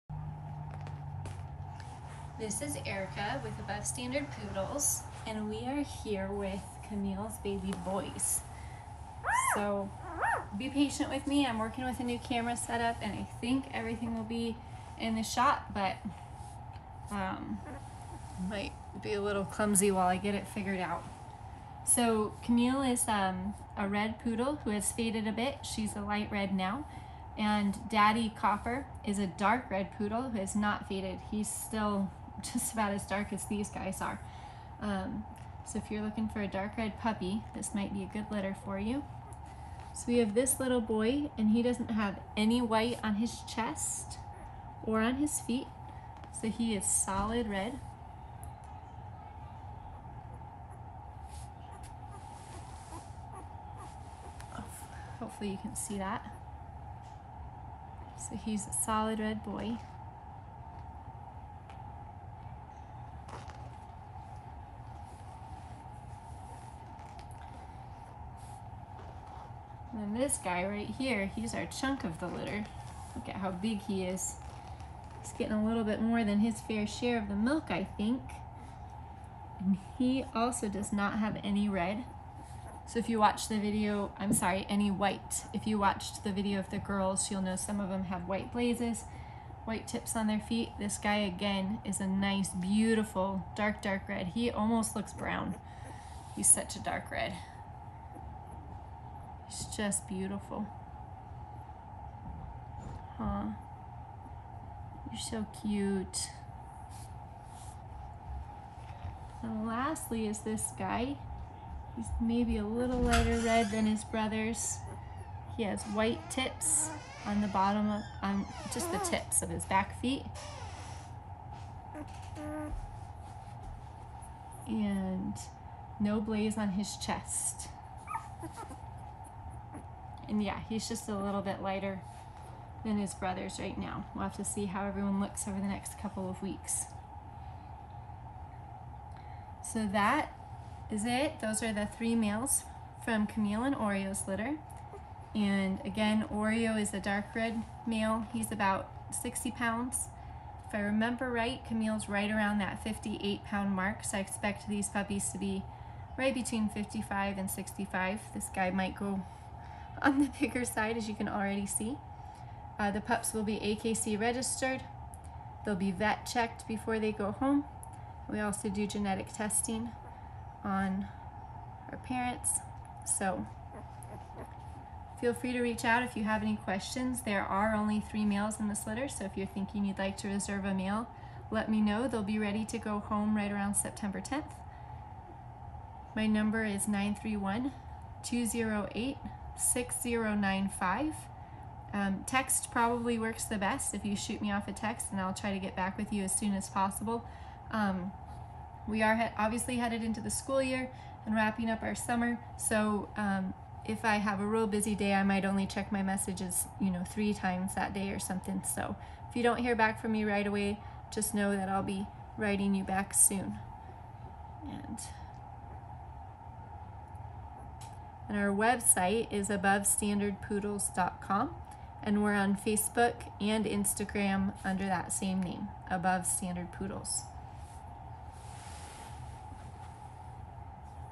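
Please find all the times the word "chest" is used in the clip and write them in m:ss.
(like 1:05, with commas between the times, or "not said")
0:43, 2:06.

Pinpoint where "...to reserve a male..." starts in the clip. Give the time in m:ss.
3:00.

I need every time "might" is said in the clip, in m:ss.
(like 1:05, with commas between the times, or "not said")
0:18, 0:37, 2:38, 3:25.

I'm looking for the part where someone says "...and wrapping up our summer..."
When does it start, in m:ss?
3:21.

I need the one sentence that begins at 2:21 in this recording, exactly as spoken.
Those are the three males from Camille and Oreo's litter.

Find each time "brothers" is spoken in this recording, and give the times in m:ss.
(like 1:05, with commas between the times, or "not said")
1:54, 2:13.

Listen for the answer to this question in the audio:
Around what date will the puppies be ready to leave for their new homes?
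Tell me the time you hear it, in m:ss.
3:03.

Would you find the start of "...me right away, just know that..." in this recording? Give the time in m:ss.
3:30.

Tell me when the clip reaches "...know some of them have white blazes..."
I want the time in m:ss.
1:27.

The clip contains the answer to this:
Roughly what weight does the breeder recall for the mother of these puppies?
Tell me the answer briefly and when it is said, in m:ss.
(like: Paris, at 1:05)
58 pounds, at 2:32.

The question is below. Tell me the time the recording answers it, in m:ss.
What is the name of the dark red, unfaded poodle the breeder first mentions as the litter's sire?
0:28.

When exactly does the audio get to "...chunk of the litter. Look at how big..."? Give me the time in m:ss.
1:11.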